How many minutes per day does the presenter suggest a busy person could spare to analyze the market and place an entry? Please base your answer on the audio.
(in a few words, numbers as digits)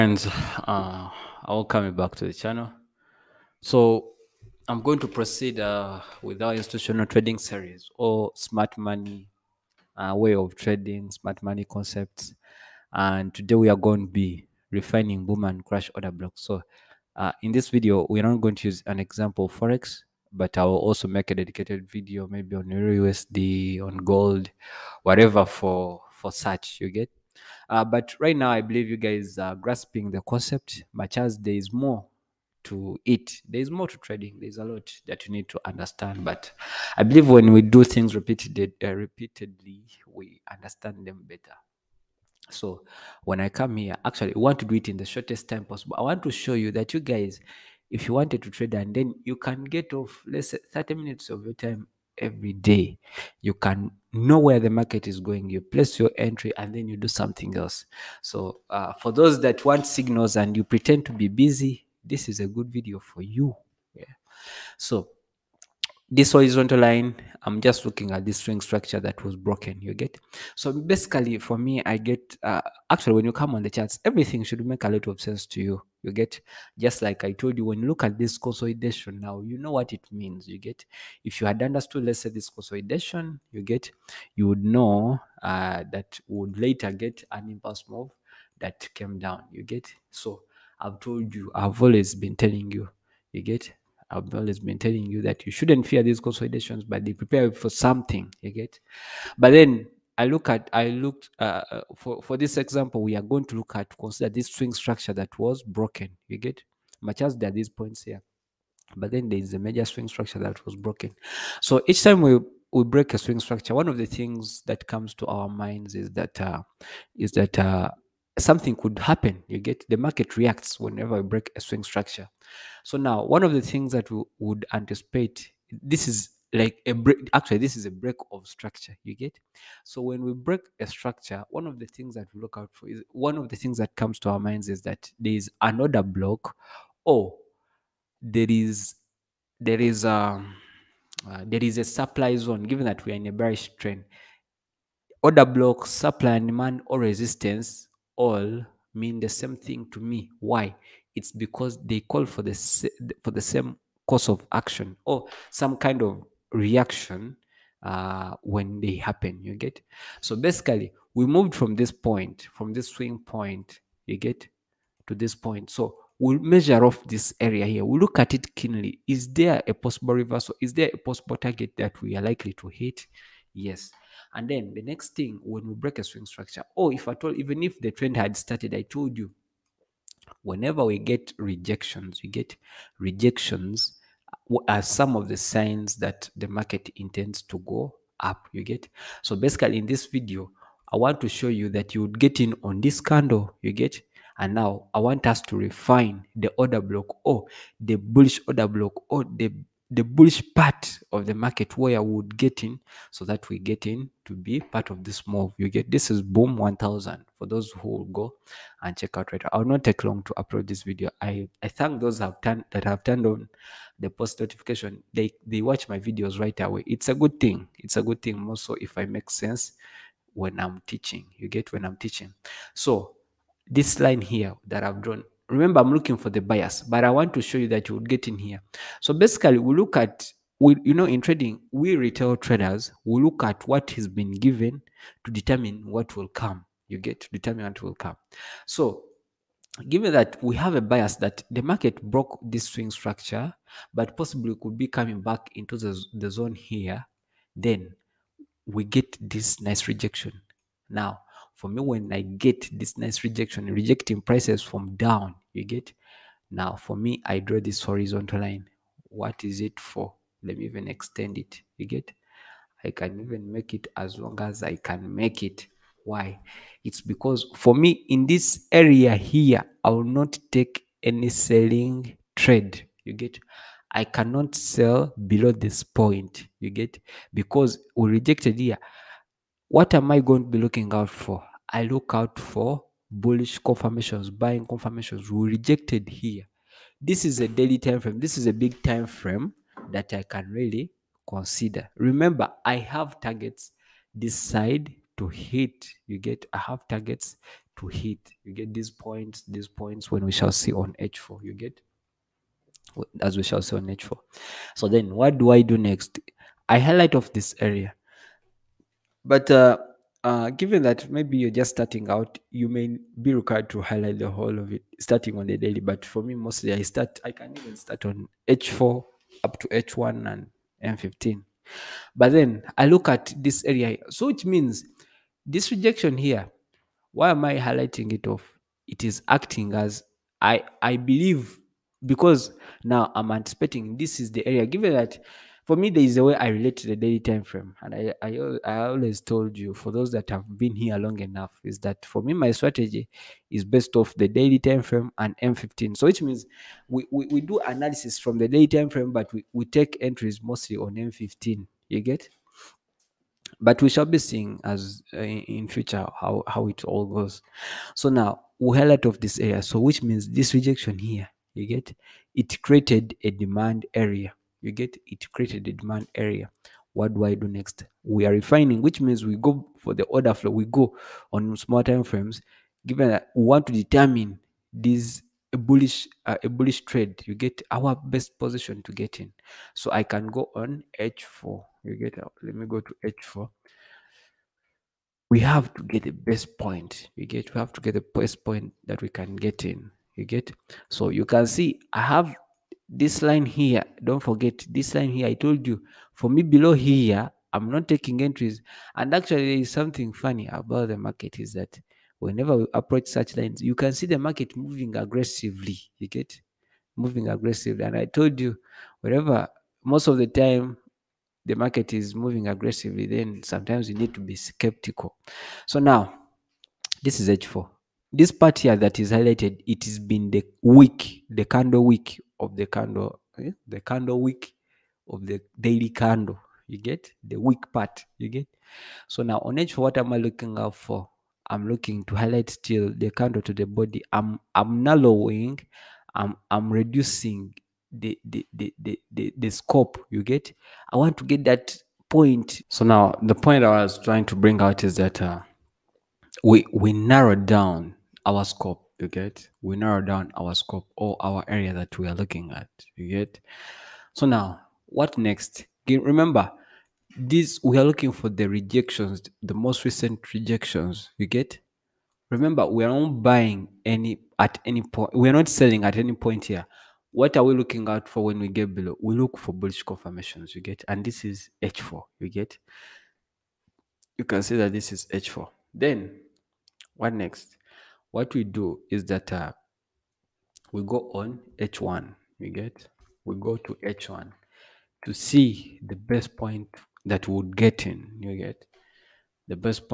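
30.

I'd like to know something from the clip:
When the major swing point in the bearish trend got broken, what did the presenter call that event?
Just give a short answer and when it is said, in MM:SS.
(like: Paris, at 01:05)
Break of structure, at 02:07.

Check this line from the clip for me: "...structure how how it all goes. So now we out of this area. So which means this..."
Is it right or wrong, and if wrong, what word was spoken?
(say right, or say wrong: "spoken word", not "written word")
wrong: "future", not "structure".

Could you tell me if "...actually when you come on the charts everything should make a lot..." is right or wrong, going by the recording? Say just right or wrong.
right.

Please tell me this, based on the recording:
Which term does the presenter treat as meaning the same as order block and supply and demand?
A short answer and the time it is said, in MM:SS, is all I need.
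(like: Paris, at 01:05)
Resistance, at 02:26.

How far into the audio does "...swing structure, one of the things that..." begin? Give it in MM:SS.
01:53.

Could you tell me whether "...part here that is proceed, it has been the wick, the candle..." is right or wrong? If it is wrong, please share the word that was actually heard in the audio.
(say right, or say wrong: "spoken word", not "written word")
wrong: "highlighted", not "proceed".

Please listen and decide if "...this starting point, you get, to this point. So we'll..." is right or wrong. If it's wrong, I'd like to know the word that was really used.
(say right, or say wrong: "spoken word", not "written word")
wrong: "swing", not "starting".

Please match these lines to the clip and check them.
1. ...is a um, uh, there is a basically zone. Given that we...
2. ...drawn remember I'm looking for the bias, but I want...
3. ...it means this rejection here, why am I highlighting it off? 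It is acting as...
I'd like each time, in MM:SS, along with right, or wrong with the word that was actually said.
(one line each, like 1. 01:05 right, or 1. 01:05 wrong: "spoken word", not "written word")
1. 02:19 wrong: "supply", not "basically"
2. 03:45 right
3. 05:24 right.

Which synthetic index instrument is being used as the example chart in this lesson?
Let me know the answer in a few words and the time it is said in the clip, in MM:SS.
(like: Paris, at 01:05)
Boom 1000, at 03:26.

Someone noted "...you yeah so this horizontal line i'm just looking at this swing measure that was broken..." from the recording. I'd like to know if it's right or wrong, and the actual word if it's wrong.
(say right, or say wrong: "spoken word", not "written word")
wrong: "structure", not "measure".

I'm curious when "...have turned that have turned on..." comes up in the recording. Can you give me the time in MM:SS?
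03:32.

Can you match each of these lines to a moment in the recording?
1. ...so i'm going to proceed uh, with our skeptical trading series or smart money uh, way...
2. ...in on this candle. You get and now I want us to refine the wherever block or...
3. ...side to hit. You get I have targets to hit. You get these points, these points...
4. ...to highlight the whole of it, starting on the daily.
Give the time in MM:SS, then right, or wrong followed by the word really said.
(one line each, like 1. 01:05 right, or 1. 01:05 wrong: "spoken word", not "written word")
1. 00:03 wrong: "institutional", not "skeptical"
2. 03:12 wrong: "order", not "wherever"
3. 04:54 right
4. 05:13 right.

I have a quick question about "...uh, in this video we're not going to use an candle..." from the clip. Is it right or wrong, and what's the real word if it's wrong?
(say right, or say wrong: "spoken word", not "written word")
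wrong: "example", not "candle".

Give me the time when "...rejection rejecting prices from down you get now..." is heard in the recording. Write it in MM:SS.
04:13.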